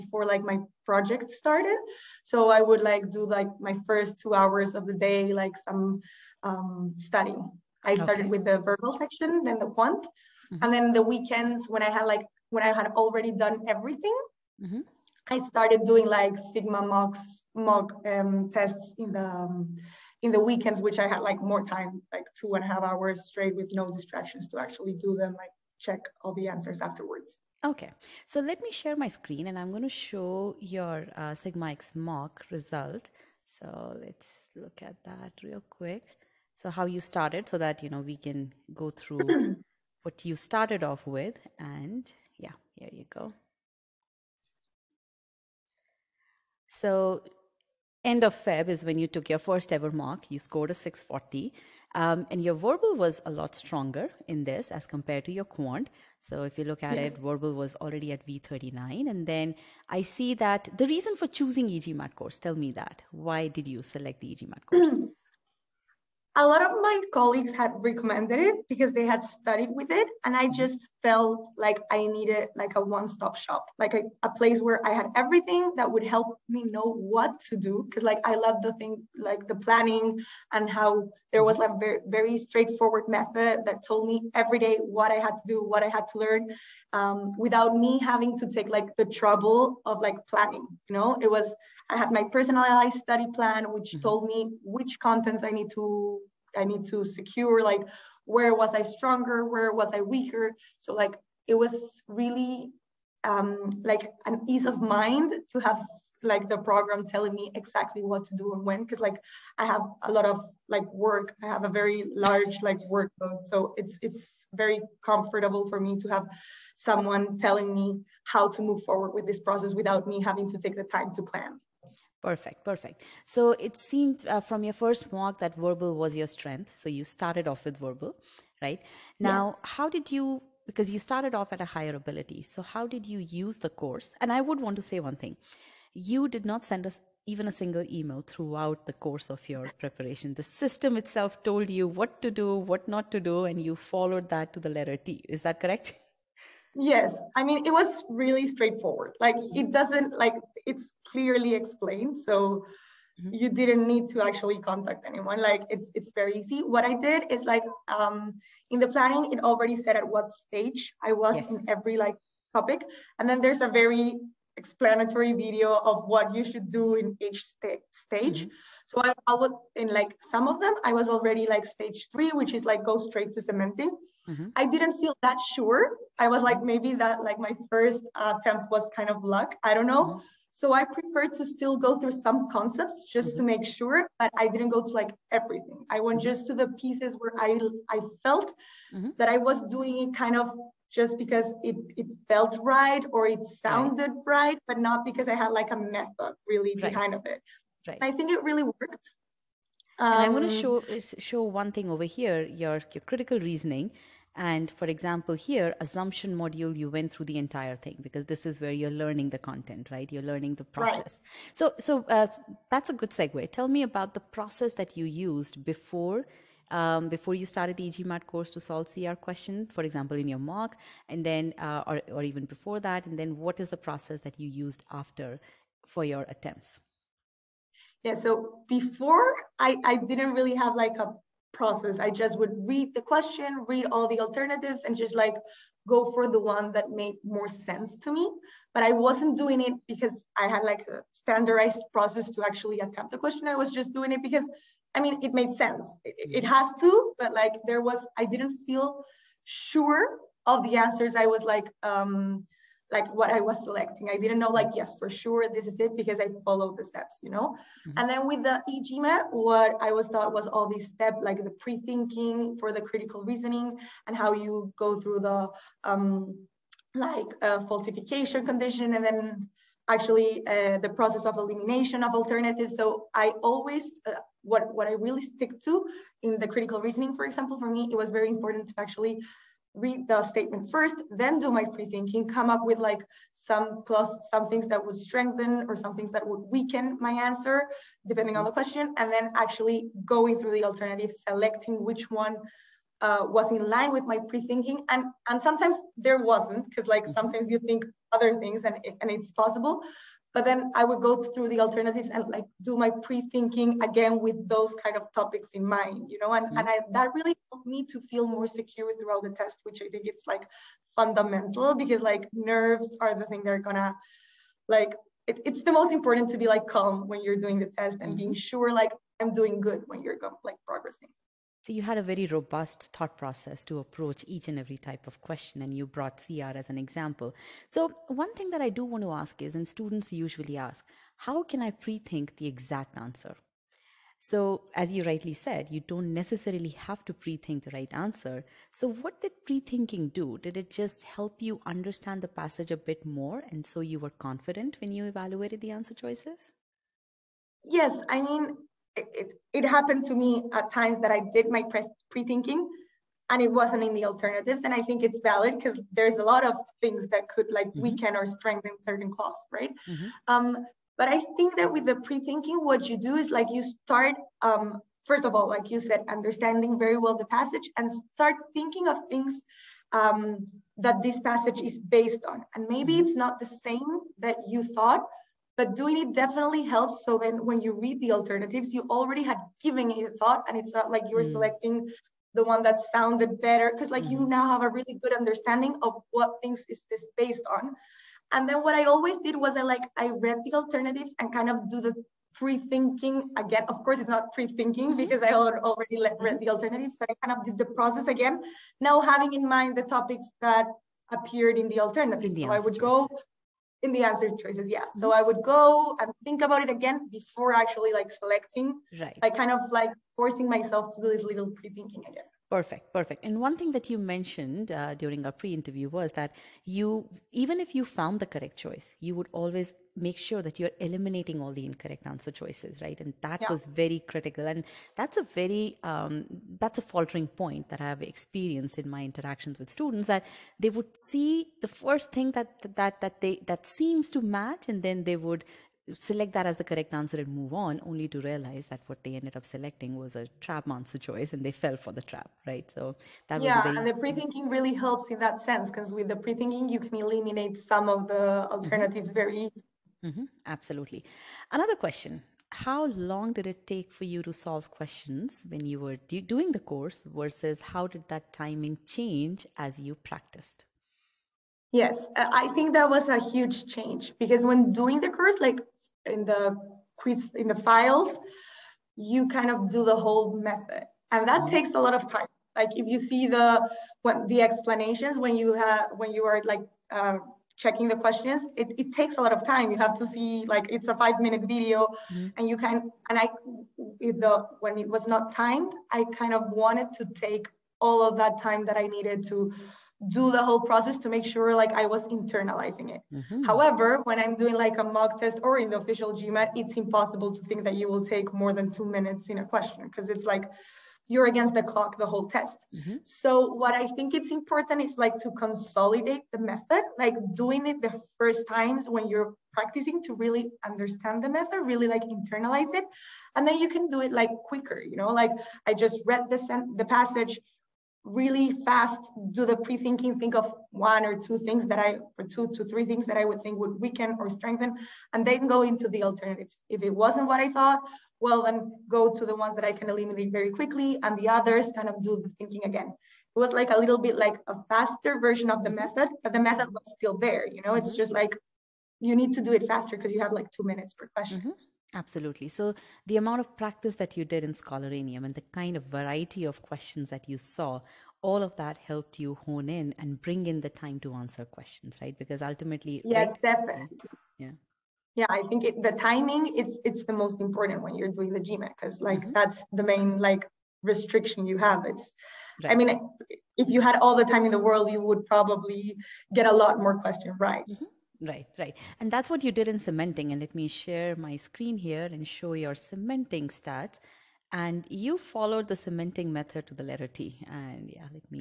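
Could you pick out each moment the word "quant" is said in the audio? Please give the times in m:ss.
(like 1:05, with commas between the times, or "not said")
0:09, 0:55.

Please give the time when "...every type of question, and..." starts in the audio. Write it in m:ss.
5:24.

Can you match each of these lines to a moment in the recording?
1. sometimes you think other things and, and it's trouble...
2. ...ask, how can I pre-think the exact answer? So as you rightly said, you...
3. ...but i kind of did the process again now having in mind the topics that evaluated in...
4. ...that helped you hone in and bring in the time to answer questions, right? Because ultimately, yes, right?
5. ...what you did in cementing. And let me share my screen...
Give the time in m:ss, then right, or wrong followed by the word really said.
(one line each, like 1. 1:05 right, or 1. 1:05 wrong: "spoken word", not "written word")
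1. 4:57 wrong: "possible", not "trouble"
2. 5:30 right
3. 6:36 wrong: "appeared", not "evaluated"
4. 9:08 right
5. 9:29 right.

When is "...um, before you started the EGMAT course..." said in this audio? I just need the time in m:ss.
3:36.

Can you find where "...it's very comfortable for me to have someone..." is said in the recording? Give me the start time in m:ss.
1:54.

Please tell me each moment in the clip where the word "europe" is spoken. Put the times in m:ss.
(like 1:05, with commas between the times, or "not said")
not said.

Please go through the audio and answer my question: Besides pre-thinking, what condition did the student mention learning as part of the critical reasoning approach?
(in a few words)
Falsification condition.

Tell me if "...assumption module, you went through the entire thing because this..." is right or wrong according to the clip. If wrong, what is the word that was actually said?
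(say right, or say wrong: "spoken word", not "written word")
right.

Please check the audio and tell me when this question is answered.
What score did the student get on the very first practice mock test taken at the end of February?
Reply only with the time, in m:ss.
0:50.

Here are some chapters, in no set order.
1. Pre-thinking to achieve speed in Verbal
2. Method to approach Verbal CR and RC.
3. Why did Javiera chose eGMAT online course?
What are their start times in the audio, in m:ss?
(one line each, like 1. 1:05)
1. 7:33
2. 3:22
3. 1:01.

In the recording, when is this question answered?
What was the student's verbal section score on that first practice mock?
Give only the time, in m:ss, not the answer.
0:58.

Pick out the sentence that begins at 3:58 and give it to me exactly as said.
But I wasn't doing it because I had like a standardized process to actually attempt the question.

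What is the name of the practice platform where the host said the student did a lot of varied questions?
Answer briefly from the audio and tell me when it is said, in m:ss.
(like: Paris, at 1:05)
Scholaranium, at 9:04.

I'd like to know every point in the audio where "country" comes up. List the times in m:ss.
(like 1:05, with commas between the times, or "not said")
not said.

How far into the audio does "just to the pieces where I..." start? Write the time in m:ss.
3:06.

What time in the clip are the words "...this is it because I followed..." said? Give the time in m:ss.
4:15.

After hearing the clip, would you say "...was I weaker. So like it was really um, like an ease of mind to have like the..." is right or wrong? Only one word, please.
right.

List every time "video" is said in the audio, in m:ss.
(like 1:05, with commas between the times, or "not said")
2:45, 8:01.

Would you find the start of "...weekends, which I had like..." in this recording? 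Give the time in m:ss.
0:20.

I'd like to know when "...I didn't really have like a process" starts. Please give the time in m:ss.
3:49.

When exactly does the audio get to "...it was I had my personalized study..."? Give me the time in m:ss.
1:31.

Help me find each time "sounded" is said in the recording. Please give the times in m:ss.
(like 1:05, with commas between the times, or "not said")
3:13, 6:22.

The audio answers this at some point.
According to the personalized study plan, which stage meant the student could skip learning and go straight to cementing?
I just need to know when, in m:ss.
2:51.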